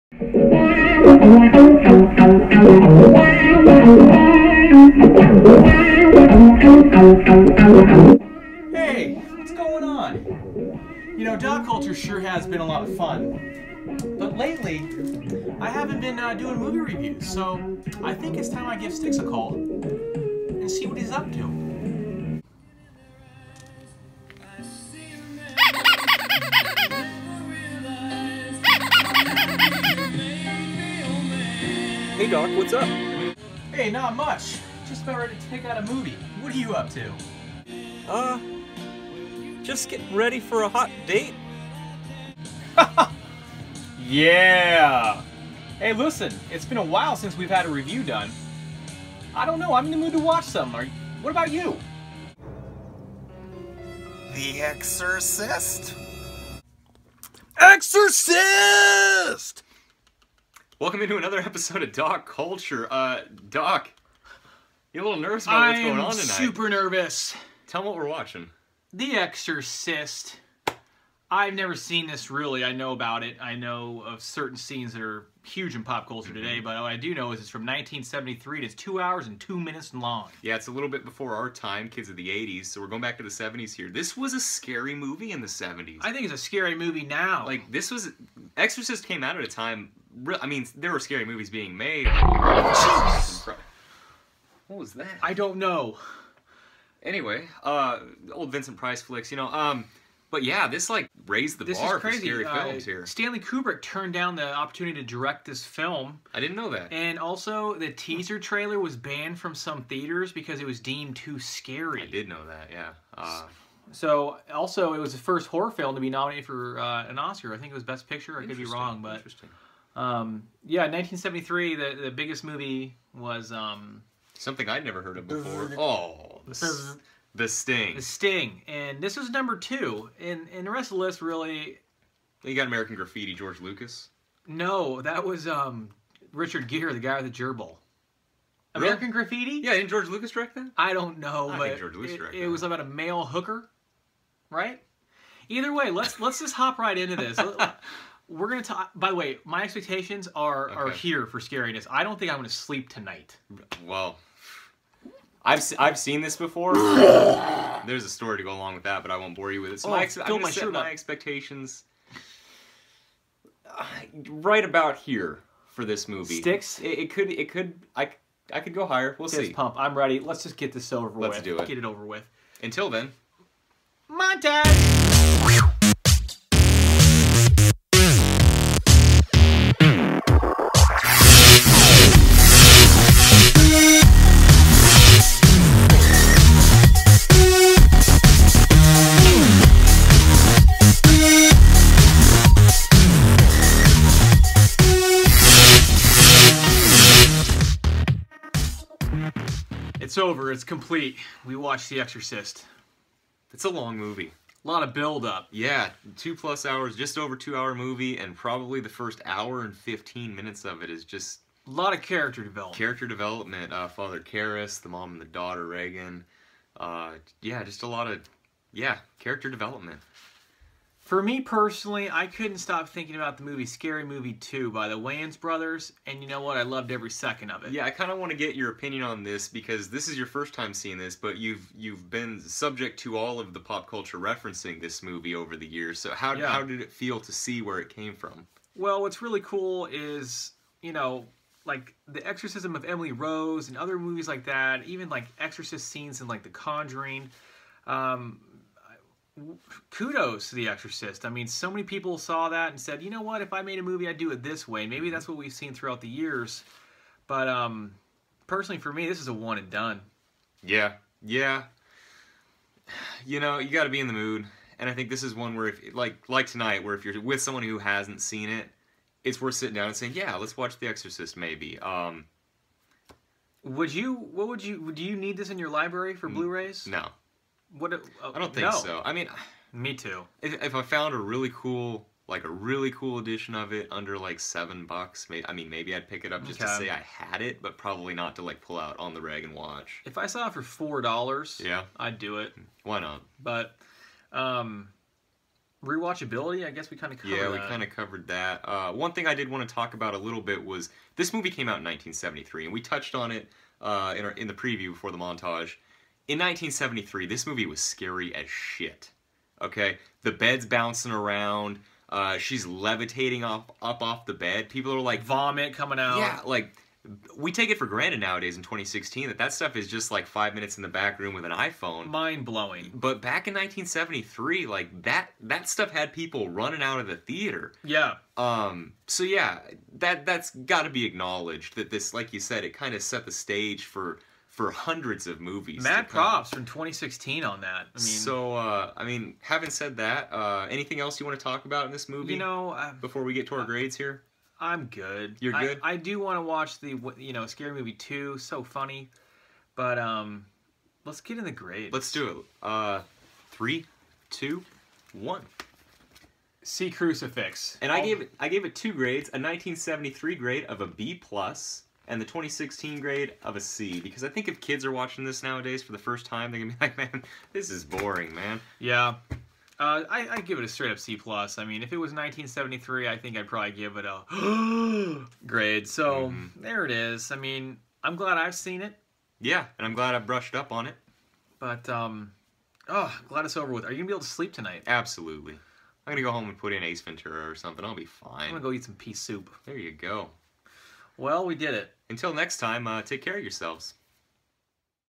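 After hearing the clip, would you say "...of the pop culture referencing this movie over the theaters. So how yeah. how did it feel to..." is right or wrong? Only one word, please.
wrong.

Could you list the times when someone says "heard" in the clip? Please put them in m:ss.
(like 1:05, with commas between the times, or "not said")
2:05.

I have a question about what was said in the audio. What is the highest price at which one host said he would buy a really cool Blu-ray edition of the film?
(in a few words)
$7.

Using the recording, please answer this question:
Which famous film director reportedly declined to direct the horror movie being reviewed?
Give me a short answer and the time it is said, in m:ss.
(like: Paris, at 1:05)
Stanley Kubrick, at 1:43.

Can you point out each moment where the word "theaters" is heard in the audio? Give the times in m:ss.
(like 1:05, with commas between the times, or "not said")
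1:49, 5:27.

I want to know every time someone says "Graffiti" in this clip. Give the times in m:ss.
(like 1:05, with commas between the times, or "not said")
2:12, 2:19.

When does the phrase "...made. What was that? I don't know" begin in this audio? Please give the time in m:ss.
1:31.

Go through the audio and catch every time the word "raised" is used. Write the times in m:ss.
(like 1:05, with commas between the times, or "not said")
1:41.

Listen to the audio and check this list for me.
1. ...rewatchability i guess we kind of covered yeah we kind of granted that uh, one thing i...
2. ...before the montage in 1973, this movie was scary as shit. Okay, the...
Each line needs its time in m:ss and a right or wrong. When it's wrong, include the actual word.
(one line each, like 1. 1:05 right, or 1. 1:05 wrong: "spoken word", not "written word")
1. 4:55 wrong: "covered", not "granted"
2. 5:04 right.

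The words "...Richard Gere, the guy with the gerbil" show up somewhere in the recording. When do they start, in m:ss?
2:16.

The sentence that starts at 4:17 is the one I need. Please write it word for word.
But um, personally, for me, this is a one and done.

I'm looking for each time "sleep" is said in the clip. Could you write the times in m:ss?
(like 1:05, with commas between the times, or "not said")
2:32, 6:24.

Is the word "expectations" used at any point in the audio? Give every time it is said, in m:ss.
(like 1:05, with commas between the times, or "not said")
2:29, 2:40.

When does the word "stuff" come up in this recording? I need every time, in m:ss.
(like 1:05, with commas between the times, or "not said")
5:19, 5:25.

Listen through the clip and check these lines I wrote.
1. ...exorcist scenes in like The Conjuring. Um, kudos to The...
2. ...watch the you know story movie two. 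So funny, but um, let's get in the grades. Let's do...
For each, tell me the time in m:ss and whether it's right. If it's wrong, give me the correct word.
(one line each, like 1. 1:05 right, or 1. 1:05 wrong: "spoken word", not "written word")
1. 4:05 right
2. 5:46 wrong: "scary", not "story".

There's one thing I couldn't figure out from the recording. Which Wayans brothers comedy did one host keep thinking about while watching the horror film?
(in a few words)
Scary Movie 2.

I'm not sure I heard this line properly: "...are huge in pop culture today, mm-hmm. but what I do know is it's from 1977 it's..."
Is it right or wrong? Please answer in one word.
wrong.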